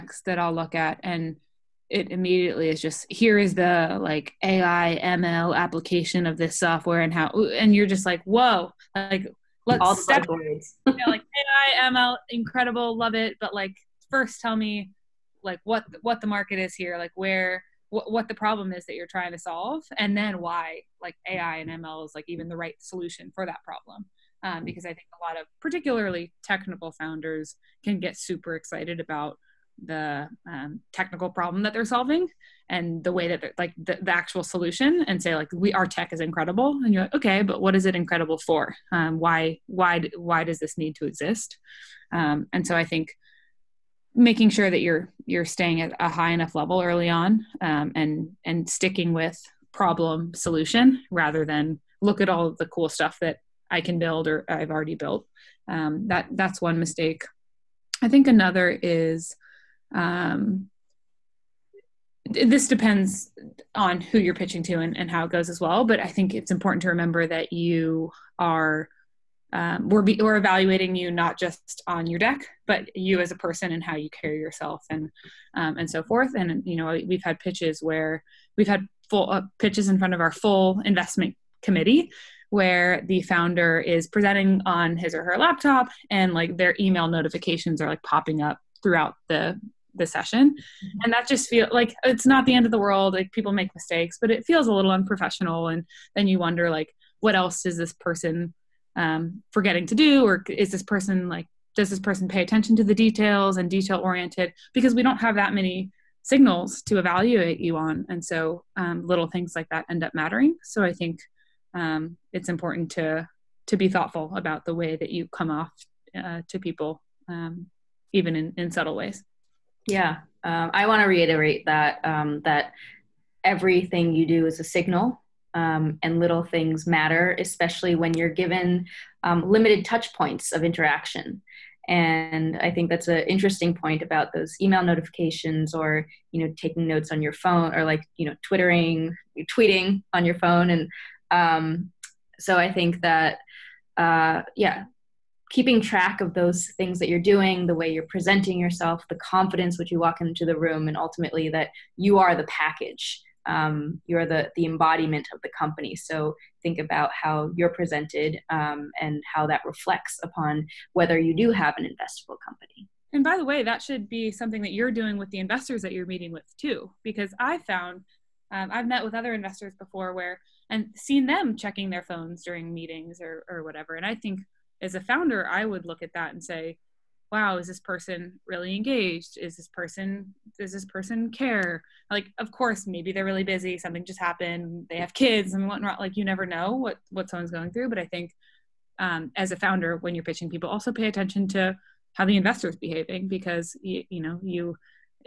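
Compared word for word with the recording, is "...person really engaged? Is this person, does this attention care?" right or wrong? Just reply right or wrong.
wrong.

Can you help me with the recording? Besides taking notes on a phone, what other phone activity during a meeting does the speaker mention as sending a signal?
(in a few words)
tweeting.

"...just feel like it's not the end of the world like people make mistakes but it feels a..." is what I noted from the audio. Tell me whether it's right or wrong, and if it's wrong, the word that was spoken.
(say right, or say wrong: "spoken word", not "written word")
right.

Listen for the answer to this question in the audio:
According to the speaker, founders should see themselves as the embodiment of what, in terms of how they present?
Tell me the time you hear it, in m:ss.
2:35.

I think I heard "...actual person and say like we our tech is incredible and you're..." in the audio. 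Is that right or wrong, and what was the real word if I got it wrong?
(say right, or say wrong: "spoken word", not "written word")
wrong: "solution", not "person".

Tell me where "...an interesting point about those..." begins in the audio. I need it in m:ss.
2:13.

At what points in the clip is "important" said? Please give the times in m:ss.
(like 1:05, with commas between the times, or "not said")
1:06, 1:52.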